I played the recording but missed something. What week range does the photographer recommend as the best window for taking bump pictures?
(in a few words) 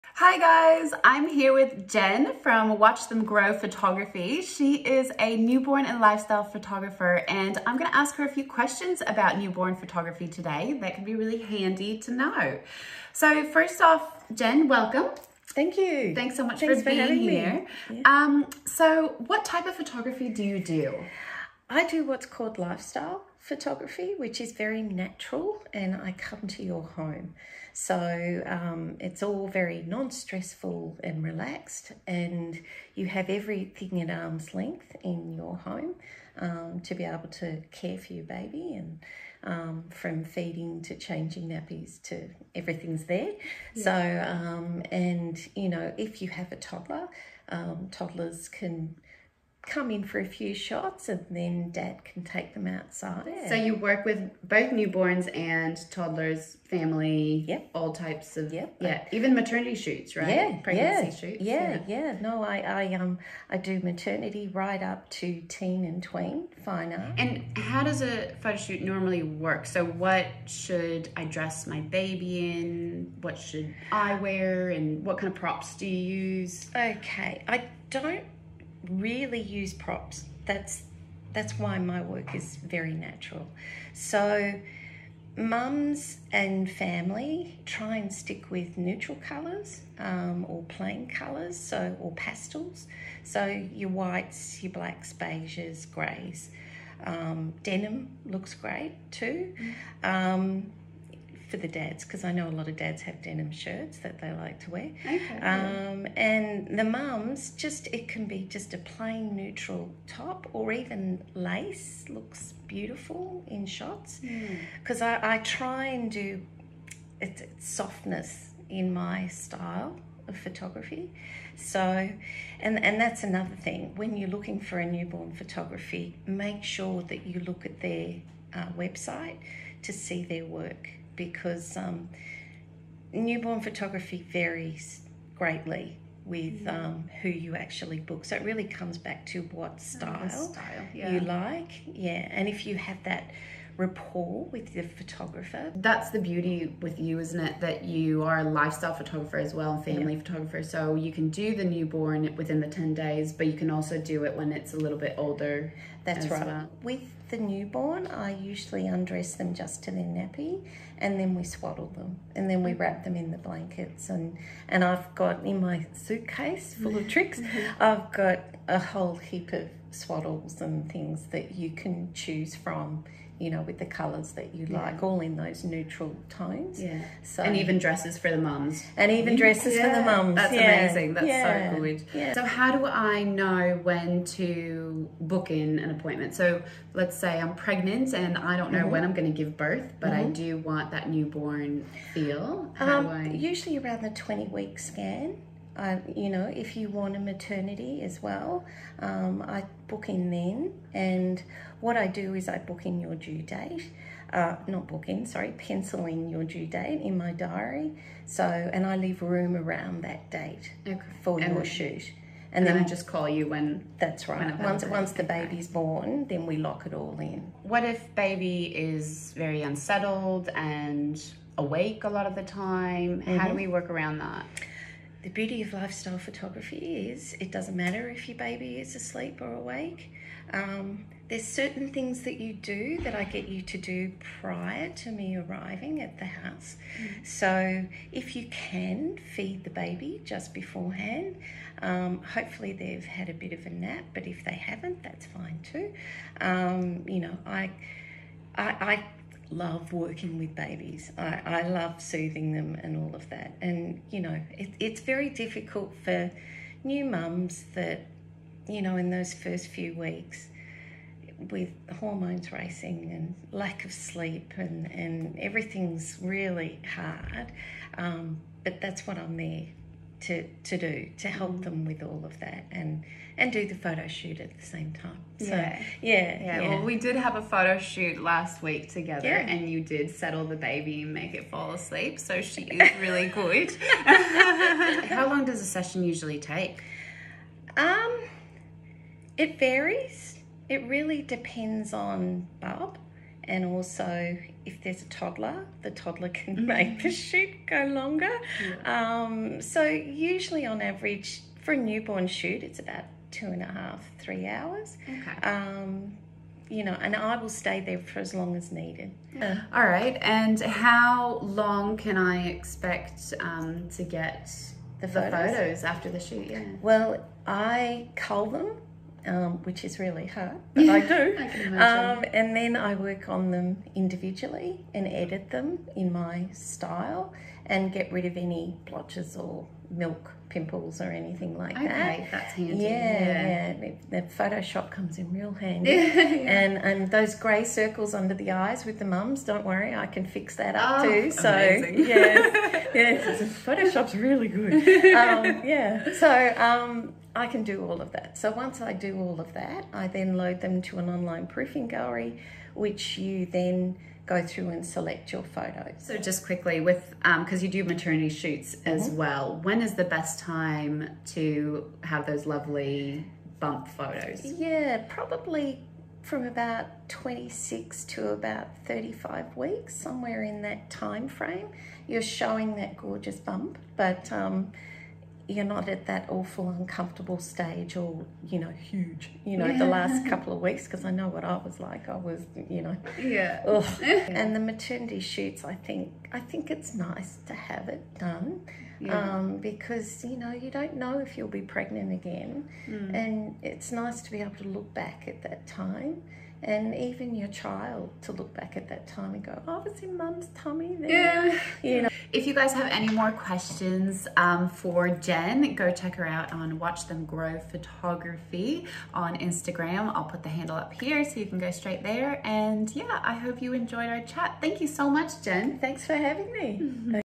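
26 to 35 weeks.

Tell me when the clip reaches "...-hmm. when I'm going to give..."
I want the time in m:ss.
3:08.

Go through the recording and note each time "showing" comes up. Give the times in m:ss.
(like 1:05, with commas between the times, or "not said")
6:12.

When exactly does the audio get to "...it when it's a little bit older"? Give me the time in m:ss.
2:34.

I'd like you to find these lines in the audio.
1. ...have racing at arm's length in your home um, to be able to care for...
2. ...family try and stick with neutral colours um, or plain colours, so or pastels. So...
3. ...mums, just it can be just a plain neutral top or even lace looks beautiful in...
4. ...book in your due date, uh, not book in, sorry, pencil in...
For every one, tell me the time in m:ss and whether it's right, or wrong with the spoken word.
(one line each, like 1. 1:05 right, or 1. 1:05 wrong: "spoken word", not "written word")
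1. 0:33 wrong: "everything", not "racing"
2. 1:26 right
3. 1:46 right
4. 3:22 right.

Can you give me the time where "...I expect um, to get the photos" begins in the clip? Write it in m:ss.
5:12.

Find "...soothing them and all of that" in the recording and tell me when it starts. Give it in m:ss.
4:12.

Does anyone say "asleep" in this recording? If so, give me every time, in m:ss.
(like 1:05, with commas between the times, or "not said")
3:48, 4:41.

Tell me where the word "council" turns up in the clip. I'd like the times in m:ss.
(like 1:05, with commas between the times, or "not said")
not said.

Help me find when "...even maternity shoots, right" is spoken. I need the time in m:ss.
0:59.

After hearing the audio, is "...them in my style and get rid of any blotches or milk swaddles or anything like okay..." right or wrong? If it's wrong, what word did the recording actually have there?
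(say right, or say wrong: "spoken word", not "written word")
wrong: "pimples", not "swaddles".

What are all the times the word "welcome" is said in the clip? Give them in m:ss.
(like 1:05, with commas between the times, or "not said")
0:14.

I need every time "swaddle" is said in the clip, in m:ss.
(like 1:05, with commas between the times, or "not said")
2:41, 2:49.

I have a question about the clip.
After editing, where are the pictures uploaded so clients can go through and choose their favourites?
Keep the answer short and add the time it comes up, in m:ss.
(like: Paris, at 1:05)
Online proofing gallery, at 5:51.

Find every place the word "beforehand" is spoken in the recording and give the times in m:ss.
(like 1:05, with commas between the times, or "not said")
4:00.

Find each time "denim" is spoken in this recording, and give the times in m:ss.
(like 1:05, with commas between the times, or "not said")
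1:37, 1:43.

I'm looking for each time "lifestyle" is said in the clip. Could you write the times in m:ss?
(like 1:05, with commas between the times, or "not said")
0:05, 0:22, 2:28, 3:45.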